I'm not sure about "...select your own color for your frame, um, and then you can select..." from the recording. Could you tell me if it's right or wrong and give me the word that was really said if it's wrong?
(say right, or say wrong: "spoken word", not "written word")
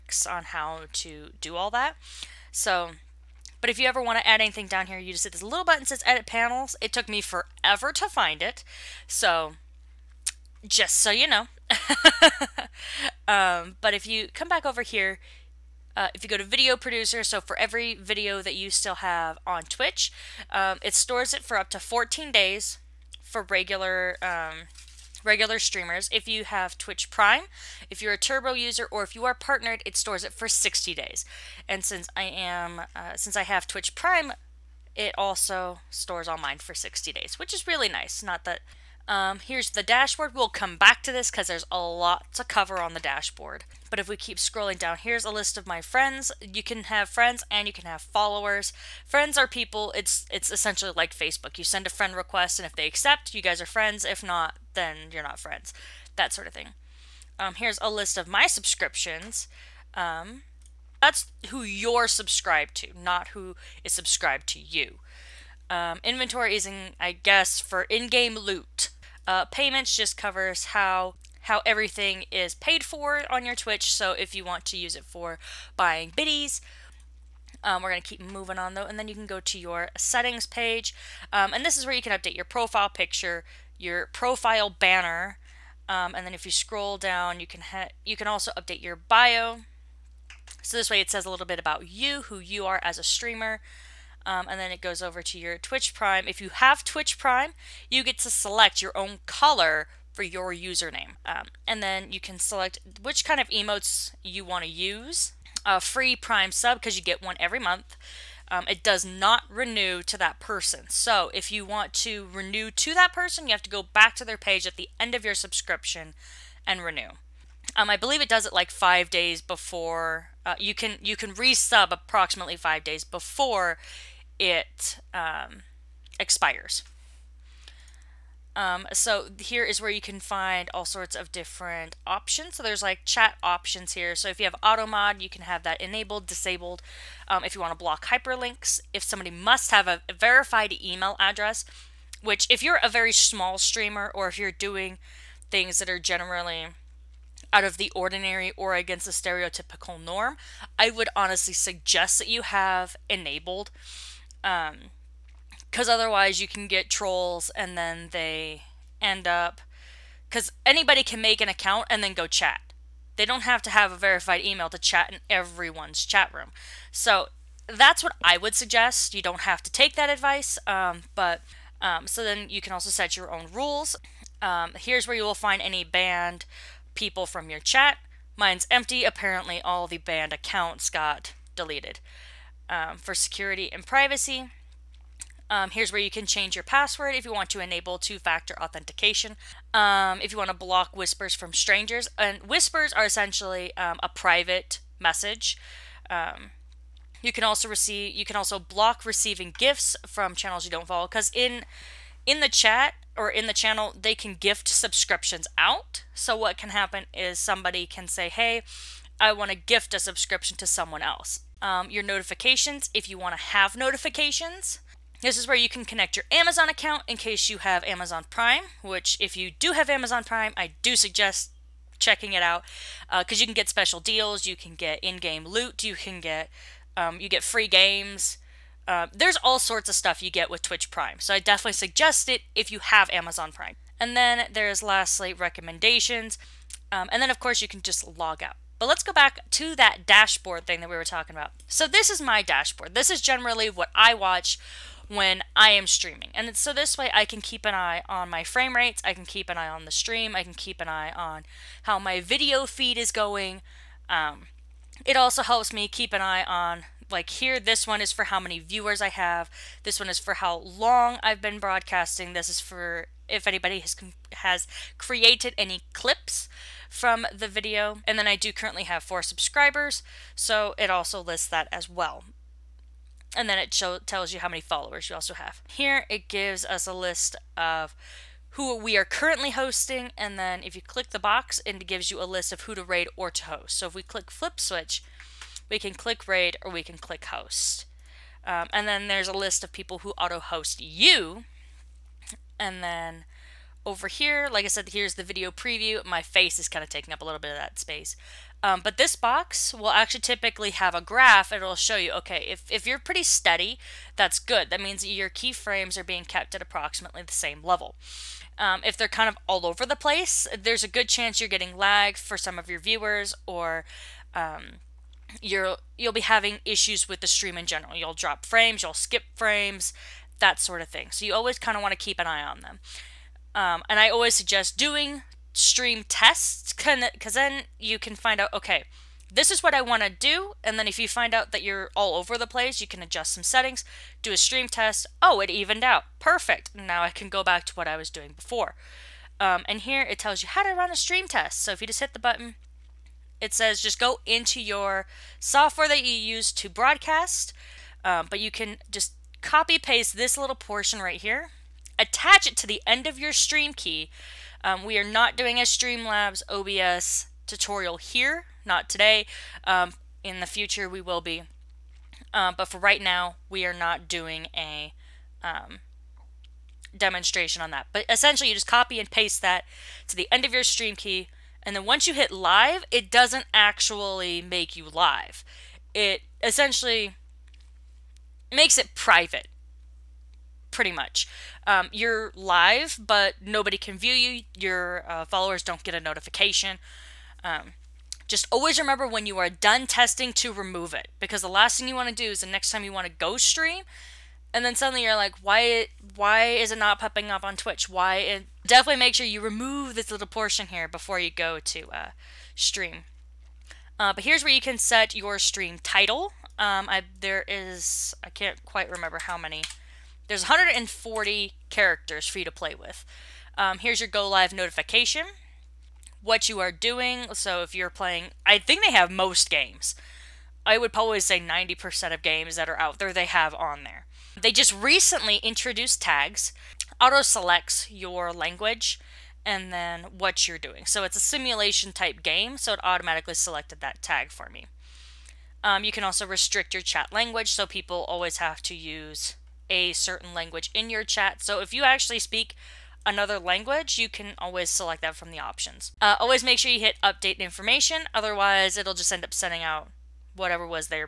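wrong: "username", not "frame".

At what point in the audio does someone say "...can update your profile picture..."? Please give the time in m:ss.
1:22.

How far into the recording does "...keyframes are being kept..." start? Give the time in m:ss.
5:05.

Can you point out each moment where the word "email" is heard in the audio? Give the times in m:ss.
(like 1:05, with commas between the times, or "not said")
2:20, 2:44.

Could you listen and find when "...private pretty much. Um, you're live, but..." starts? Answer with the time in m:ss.
6:18.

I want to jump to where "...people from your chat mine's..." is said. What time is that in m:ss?
2:56.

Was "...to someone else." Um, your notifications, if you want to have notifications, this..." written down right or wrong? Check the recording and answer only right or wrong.
right.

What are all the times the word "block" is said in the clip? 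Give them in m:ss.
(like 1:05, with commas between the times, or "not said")
2:17, 3:10, 3:18.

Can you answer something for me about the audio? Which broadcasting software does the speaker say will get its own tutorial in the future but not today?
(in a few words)
Streamlabs OBS.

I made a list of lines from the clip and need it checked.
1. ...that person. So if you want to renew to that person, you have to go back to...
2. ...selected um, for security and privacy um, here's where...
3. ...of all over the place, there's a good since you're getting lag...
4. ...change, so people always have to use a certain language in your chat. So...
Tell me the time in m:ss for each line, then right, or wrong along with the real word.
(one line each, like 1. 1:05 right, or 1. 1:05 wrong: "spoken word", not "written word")
1. 1:50 right
2. 3:01 wrong: "deleted", not "selected"
3. 5:09 wrong: "chance", not "since"
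4. 7:17 wrong: "language", not "change".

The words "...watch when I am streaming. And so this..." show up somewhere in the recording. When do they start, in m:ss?
4:04.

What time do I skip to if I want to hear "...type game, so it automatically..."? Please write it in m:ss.
7:11.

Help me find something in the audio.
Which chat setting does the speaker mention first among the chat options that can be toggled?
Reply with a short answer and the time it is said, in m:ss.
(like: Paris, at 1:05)
Auto mod, at 2:14.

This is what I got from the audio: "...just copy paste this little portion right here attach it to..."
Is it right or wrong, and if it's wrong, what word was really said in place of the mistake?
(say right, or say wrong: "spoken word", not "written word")
right.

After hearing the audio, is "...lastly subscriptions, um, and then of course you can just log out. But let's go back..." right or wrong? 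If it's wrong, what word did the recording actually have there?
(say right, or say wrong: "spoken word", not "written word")
wrong: "recommendations", not "subscriptions".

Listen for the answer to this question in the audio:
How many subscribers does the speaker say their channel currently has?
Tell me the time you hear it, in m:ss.
4:29.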